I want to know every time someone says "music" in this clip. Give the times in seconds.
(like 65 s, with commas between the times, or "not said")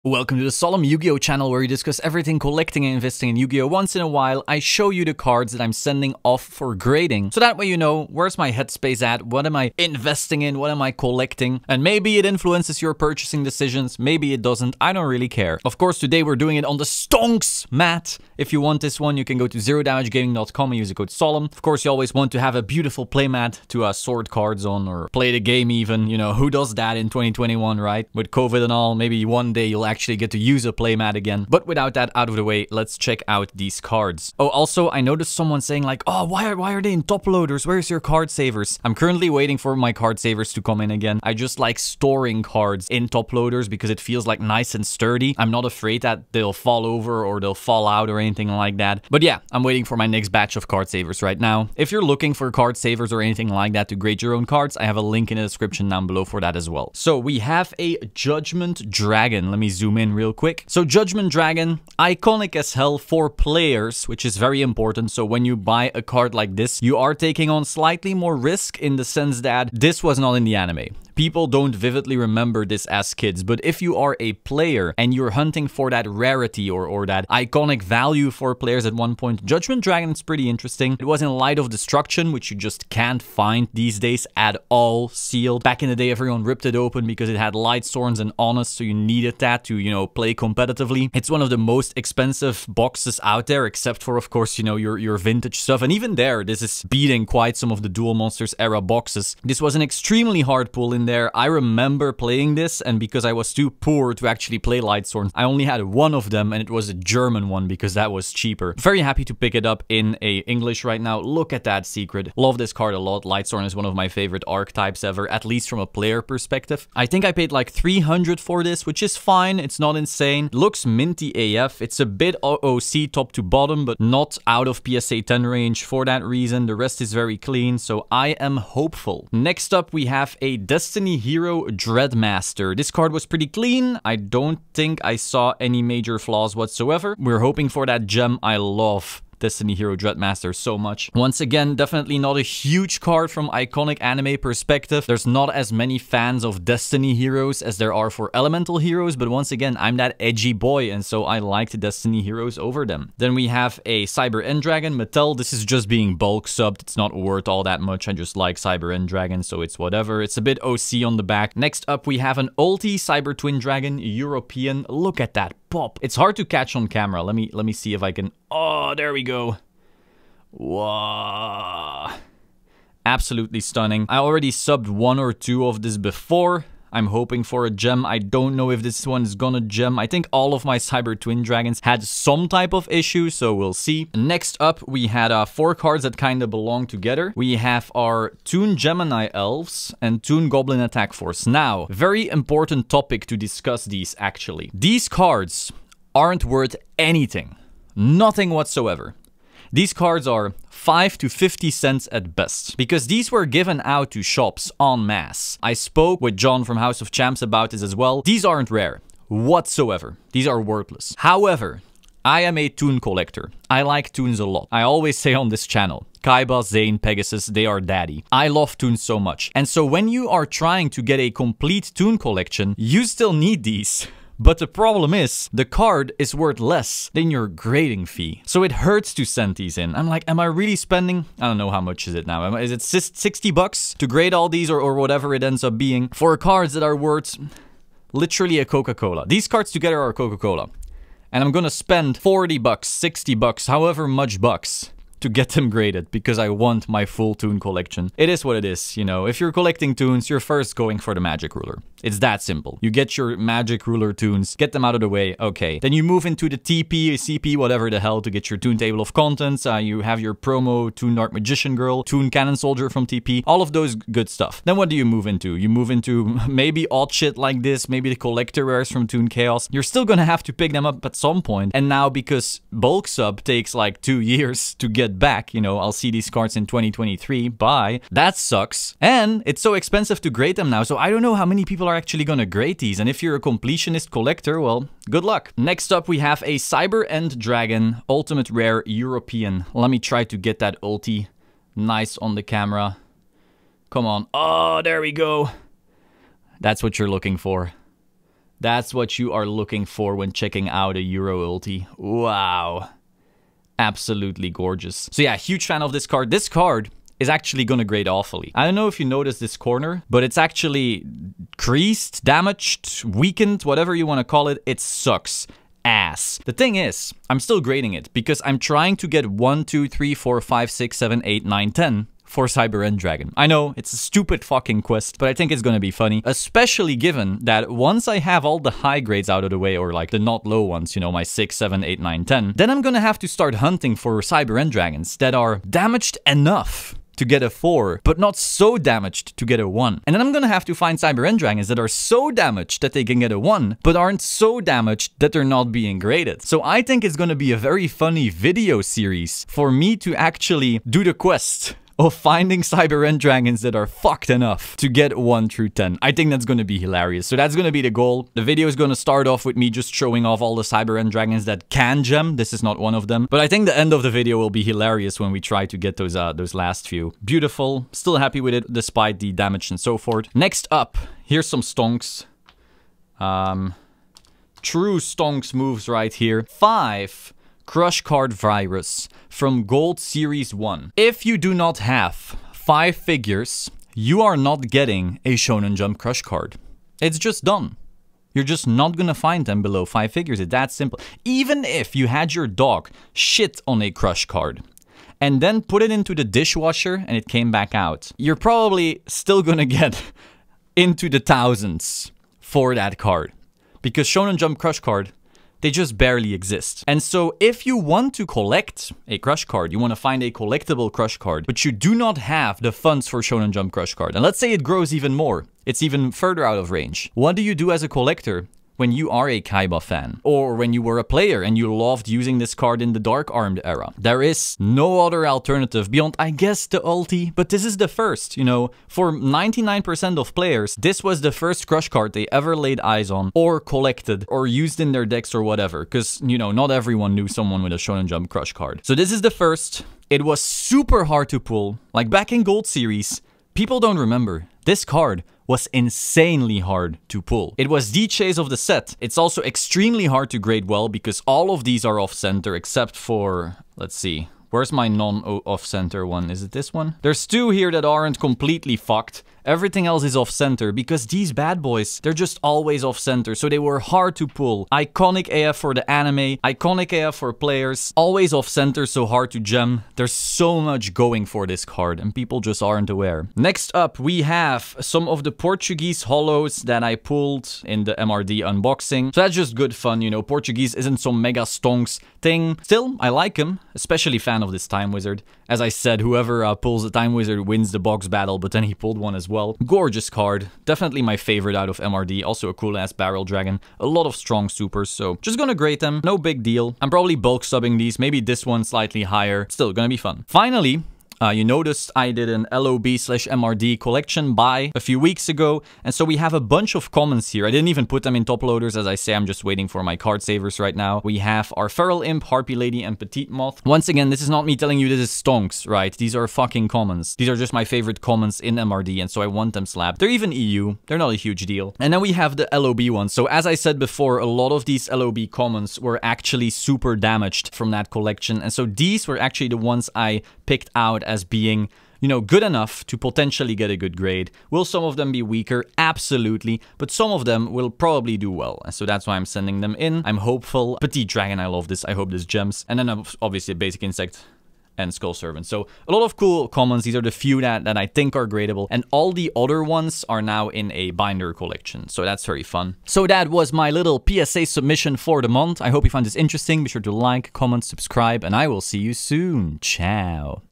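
not said.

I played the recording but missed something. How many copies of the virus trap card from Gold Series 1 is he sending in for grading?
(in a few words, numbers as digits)
Five.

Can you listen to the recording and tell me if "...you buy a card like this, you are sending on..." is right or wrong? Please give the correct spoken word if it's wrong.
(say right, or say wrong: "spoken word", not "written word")
wrong: "taking", not "sending".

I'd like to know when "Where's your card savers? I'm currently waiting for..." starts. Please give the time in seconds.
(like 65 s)
37 s.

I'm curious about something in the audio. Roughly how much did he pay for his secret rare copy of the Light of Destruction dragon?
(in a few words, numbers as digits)
300.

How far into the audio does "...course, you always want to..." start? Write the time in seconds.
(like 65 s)
21 s.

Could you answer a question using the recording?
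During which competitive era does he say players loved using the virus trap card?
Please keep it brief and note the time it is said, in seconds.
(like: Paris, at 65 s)
Dark Armed era, at 422 s.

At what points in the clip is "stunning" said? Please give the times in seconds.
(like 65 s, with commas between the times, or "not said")
173 s.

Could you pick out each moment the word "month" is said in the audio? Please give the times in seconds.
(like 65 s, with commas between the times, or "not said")
555 s.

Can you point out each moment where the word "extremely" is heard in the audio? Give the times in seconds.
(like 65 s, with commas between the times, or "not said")
99 s, 449 s.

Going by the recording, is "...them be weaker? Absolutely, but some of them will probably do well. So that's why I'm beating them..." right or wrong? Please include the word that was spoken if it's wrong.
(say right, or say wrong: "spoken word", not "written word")
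wrong: "sending", not "beating".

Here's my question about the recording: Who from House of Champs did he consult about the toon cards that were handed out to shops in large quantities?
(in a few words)
John.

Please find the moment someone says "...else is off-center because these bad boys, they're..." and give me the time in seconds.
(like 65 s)
459 s.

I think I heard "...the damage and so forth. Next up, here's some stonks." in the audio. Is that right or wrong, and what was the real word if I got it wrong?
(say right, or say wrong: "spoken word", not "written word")
right.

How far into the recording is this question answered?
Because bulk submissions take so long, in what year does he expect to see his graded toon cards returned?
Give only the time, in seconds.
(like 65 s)
276 s.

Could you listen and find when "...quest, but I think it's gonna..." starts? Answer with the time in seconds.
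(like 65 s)
324 s.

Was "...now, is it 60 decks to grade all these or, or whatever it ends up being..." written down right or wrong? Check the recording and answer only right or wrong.
wrong.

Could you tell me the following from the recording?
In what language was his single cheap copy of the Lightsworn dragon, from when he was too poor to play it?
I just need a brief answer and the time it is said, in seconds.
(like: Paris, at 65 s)
German, at 107 s.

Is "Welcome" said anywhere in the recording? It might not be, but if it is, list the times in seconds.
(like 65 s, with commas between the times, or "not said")
0 s.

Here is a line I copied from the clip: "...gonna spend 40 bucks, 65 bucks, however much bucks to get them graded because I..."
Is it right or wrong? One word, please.
wrong.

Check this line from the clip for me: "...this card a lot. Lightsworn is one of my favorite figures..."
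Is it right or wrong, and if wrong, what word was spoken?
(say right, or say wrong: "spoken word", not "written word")
wrong: "archetypes", not "figures".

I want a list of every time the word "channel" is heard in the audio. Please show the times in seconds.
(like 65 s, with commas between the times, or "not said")
1 s, 215 s.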